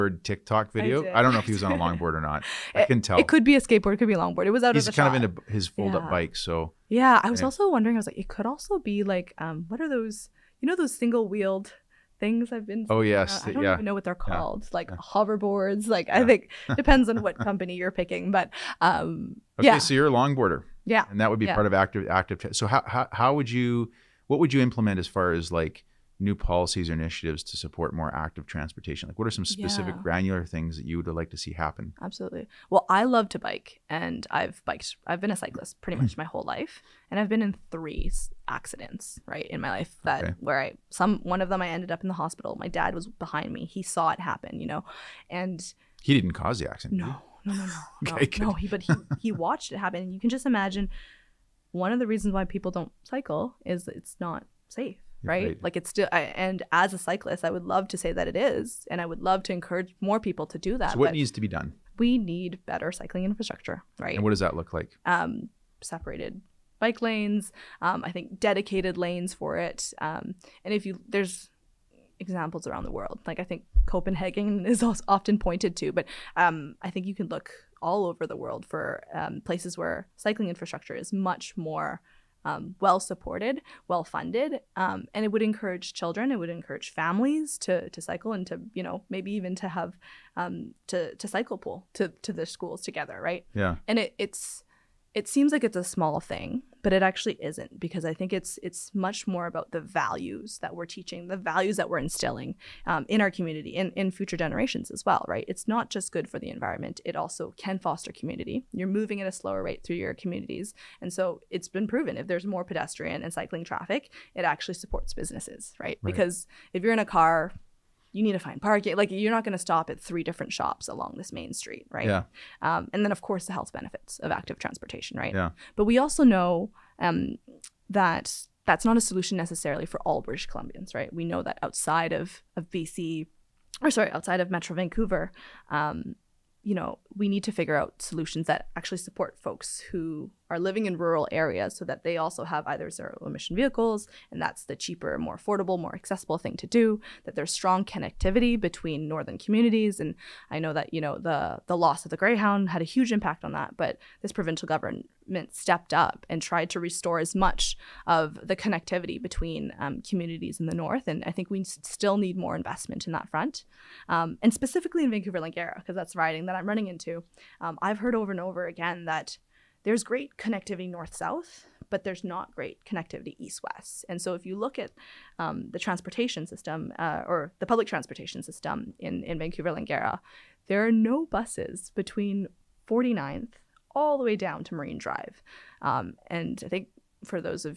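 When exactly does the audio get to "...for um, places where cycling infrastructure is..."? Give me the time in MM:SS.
01:18.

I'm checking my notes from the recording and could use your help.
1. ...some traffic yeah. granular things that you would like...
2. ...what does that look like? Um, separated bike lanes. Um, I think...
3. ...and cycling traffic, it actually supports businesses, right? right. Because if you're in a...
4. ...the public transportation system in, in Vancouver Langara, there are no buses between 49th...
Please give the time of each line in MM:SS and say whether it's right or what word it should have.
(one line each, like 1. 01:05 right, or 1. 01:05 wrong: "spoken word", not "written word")
1. 00:29 wrong: "specific", not "traffic"
2. 01:04 right
3. 01:53 right
4. 02:57 right.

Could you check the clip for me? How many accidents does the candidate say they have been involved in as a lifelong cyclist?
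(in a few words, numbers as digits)
3.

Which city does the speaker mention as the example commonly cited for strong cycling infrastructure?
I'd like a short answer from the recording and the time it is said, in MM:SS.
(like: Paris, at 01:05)
Copenhagen, at 01:13.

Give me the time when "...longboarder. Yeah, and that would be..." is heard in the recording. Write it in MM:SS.
00:20.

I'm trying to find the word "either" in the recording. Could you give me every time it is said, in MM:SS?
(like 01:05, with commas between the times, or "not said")
02:22.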